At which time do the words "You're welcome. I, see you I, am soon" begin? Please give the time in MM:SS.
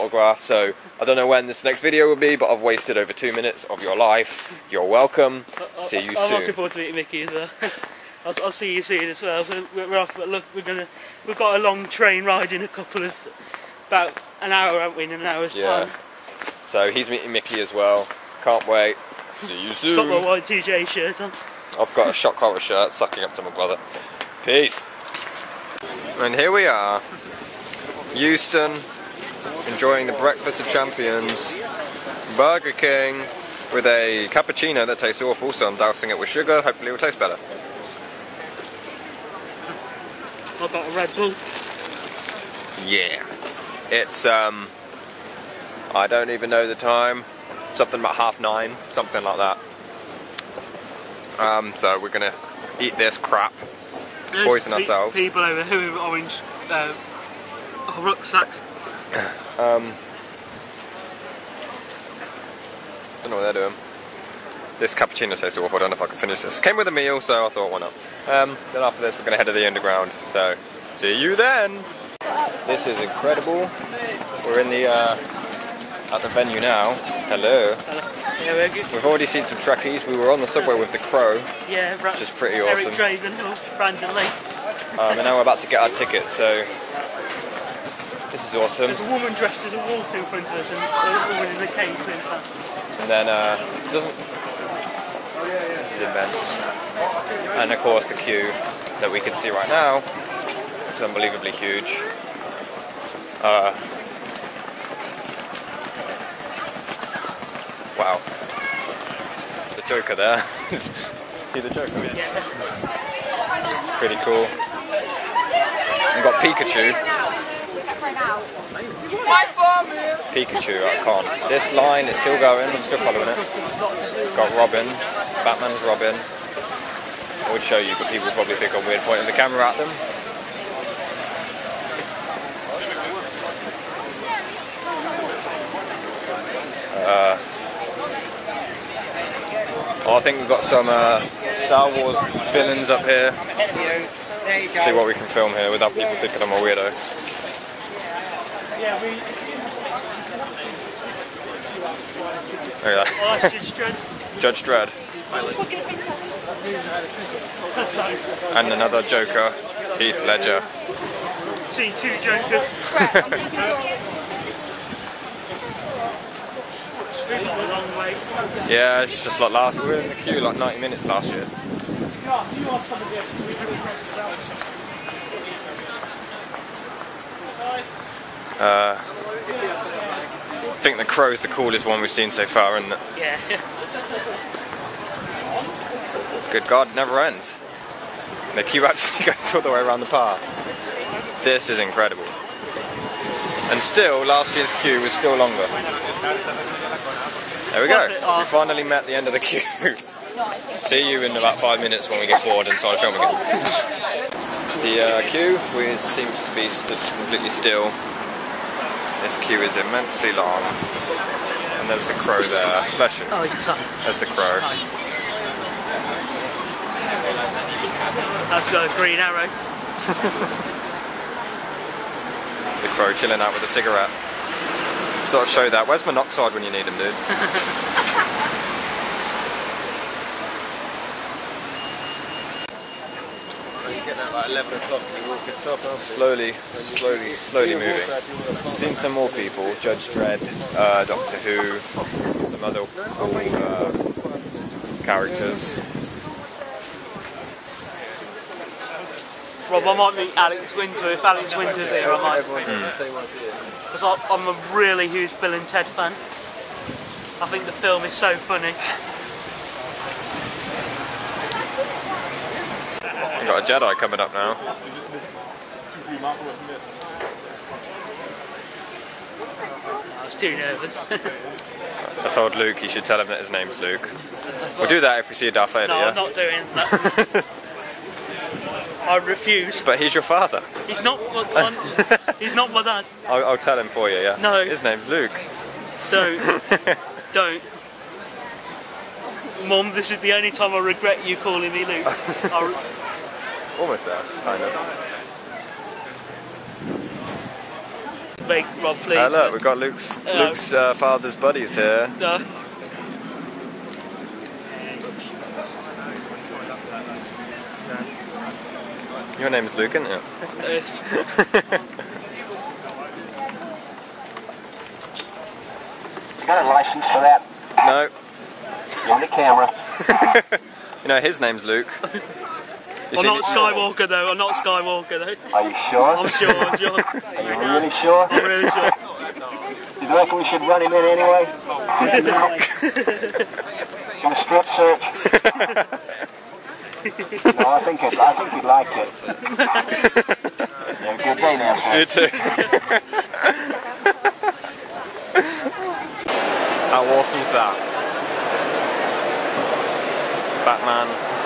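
00:04.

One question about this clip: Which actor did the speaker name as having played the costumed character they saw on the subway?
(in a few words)
Brandon Lee.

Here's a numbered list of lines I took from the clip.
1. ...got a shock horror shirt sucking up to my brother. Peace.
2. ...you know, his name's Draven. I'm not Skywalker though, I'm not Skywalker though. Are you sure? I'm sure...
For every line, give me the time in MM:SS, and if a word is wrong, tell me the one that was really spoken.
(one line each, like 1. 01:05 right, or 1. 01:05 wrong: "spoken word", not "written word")
1. 00:21 right
2. 05:21 wrong: "Luke", not "Draven".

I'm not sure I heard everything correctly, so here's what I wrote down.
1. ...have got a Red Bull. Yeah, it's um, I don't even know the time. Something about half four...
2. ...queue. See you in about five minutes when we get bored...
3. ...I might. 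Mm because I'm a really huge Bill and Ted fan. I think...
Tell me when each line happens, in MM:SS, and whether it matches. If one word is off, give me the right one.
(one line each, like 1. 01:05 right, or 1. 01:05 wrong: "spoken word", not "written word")
1. 00:40 wrong: "nine", not "four"
2. 03:19 right
3. 04:12 right.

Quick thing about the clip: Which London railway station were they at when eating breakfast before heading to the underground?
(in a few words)
Euston.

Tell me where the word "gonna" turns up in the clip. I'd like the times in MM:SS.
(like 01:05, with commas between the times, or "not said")
00:10, 00:52, 01:09, 05:34.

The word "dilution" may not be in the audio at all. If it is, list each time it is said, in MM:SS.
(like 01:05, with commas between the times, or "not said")
not said.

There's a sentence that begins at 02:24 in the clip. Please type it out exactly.
See what we can film here without people thinking I'm a weirdo.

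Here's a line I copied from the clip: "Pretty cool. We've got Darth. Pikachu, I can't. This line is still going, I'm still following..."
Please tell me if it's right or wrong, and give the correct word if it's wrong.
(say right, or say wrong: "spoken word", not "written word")
wrong: "Pikachu", not "Darth".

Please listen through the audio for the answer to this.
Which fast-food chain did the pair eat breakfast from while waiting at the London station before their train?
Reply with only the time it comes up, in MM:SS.
00:32.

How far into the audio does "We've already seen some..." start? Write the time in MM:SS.
01:18.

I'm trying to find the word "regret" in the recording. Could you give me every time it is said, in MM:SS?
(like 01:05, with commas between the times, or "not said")
04:50.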